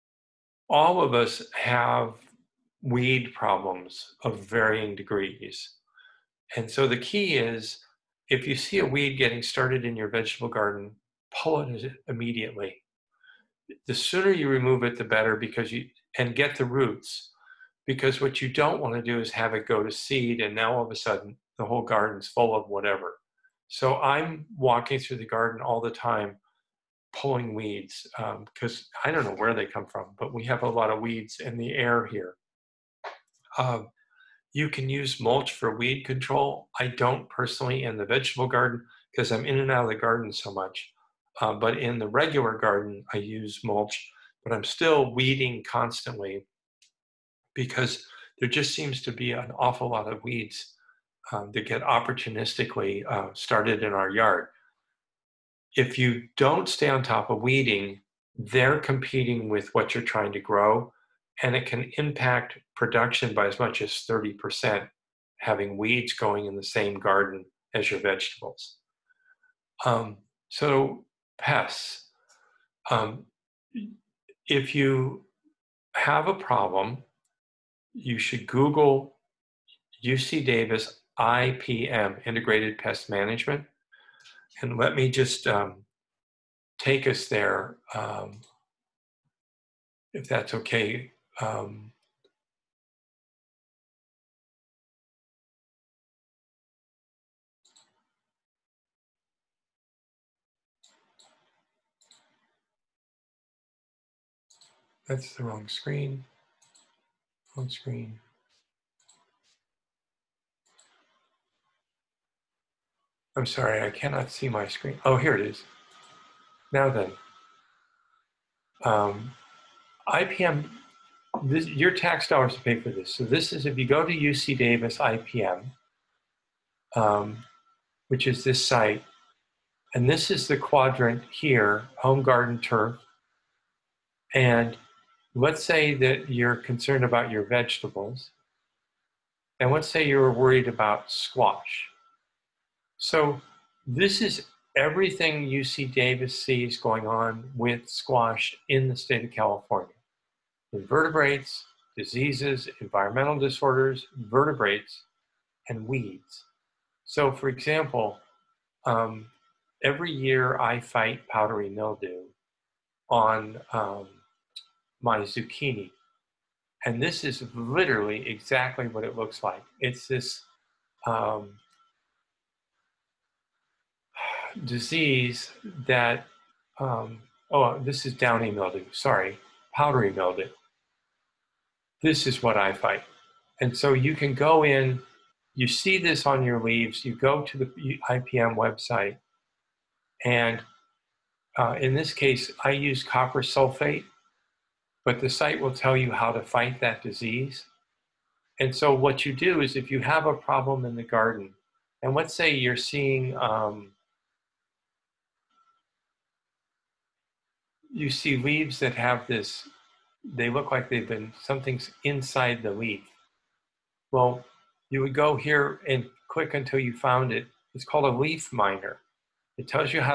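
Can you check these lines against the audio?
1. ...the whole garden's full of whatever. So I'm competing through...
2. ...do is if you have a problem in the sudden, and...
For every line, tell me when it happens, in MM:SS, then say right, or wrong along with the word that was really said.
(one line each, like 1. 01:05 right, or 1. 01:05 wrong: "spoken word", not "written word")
1. 00:21 wrong: "walking", not "competing"
2. 03:19 wrong: "garden", not "sudden".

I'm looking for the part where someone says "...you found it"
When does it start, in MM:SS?
03:36.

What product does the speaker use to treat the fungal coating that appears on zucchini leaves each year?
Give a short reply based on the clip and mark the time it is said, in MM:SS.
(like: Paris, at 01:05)
Copper sulfate, at 03:13.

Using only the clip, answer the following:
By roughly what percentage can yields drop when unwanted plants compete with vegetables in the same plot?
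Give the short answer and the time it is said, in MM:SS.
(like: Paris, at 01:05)
30%, at 01:04.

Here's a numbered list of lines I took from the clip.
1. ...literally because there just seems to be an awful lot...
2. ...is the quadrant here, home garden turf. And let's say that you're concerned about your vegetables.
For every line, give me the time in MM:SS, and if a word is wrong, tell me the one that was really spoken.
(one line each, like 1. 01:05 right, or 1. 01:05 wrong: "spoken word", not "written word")
1. 00:45 wrong: "constantly", not "literally"
2. 02:10 right.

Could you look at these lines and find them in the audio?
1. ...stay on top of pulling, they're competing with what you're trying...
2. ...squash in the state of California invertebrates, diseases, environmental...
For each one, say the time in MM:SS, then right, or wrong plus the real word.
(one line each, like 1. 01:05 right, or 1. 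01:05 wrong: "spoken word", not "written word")
1. 00:56 wrong: "weeding", not "pulling"
2. 02:27 right.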